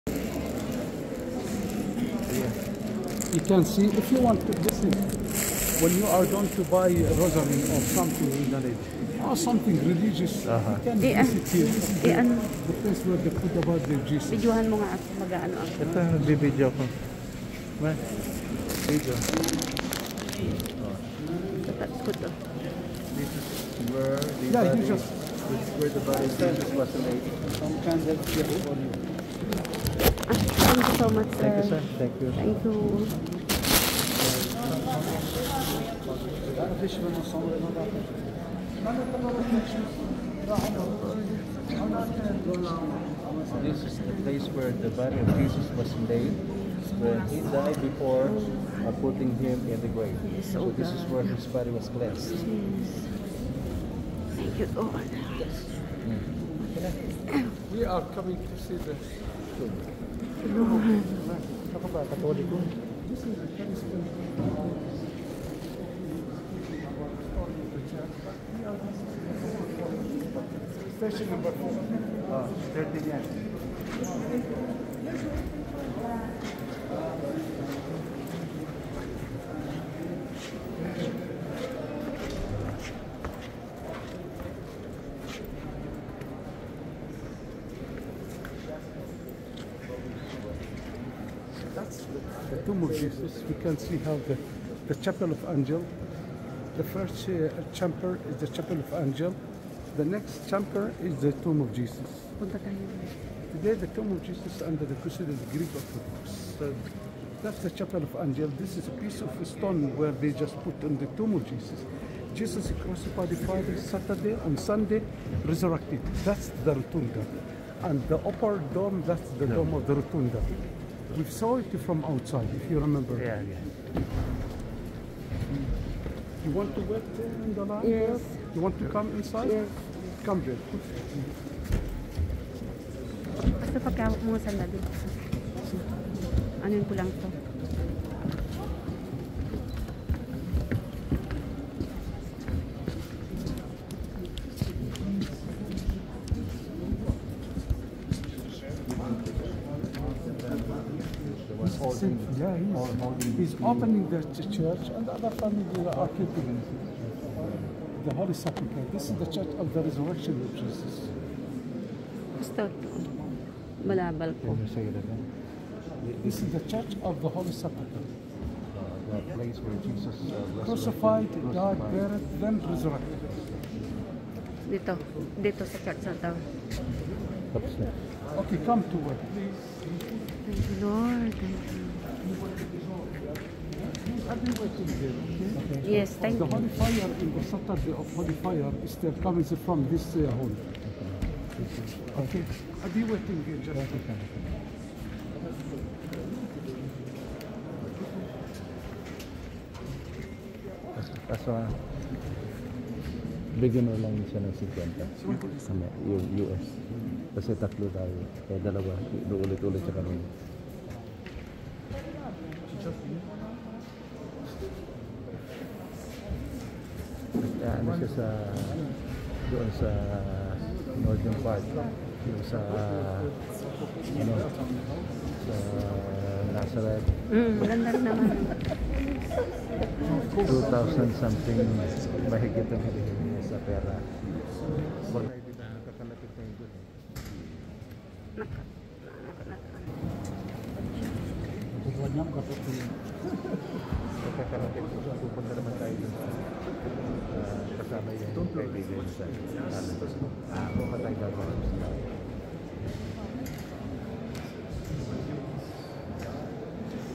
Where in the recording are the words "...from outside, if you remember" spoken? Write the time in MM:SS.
02:01.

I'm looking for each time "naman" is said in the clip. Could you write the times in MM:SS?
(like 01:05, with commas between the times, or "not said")
03:48, 04:05.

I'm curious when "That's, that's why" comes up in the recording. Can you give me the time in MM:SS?
03:20.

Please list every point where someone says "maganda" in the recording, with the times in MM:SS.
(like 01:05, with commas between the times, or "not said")
03:47.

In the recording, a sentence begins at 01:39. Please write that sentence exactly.
The next chamber is the tomb of Jesus.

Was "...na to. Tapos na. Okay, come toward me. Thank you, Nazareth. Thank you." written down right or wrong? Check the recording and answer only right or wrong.
wrong.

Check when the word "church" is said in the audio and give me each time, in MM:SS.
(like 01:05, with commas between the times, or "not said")
02:34, 02:39, 02:46, 02:55.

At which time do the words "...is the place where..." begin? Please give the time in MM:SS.
00:43.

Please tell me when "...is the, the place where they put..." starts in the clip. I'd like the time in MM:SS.
00:11.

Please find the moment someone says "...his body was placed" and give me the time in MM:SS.
00:51.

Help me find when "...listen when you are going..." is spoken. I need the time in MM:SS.
00:04.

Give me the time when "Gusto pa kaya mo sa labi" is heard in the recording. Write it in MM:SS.
02:13.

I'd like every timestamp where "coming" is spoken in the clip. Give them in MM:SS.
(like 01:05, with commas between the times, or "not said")
00:58, 03:09.